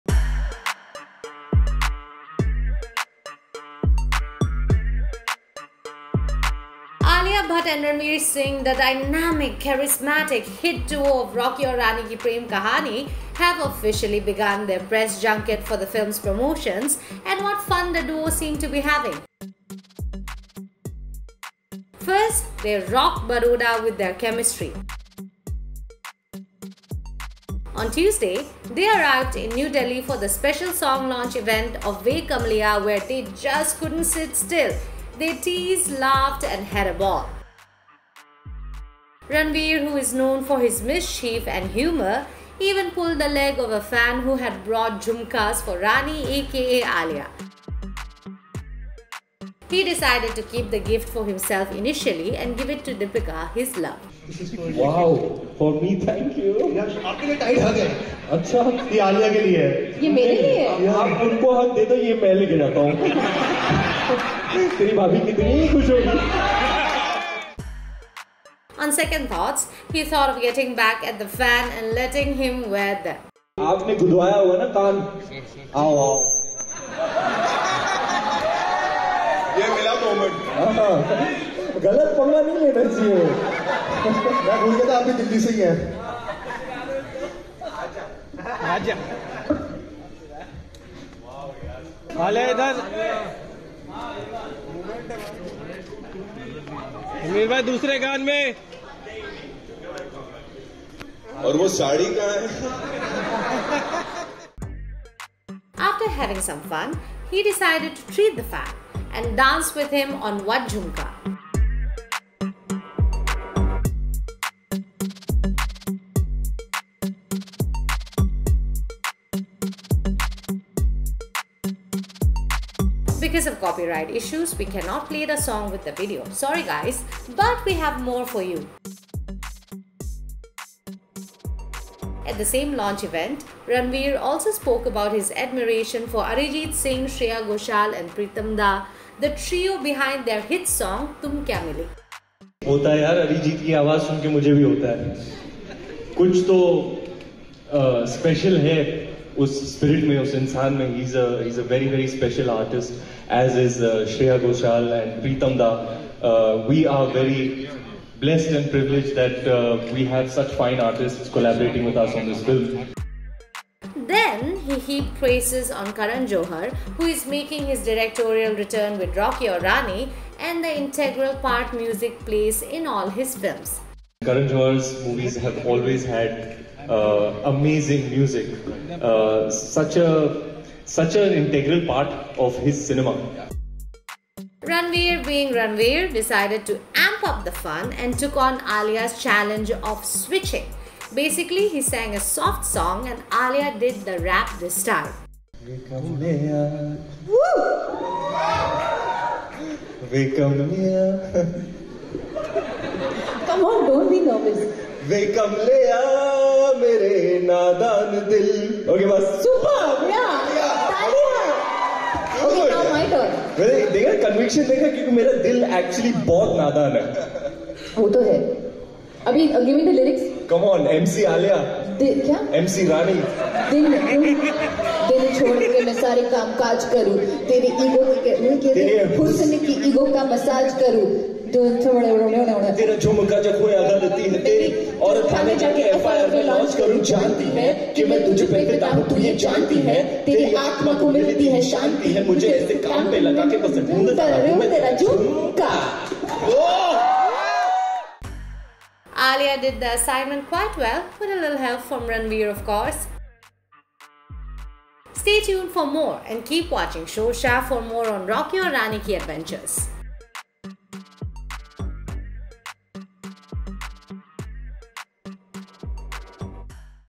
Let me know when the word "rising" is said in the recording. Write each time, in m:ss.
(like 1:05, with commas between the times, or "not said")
not said.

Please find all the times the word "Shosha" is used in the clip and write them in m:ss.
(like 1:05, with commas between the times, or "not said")
4:17.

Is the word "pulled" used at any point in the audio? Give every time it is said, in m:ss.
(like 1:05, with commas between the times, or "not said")
0:42.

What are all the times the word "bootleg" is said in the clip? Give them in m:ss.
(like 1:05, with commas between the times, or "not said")
not said.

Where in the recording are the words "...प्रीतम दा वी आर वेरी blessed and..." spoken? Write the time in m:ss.
2:35.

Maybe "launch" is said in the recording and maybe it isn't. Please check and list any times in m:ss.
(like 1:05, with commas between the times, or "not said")
0:31, 2:12.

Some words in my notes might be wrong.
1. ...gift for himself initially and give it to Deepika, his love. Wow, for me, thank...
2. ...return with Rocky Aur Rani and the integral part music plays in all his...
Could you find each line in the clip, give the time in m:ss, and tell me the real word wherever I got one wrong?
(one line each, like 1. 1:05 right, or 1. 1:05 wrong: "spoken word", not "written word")
1. 0:50 right
2. 2:48 right.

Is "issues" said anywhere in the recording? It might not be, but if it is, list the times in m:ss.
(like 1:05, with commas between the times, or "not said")
2:04.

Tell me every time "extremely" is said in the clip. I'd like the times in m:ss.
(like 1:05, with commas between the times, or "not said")
not said.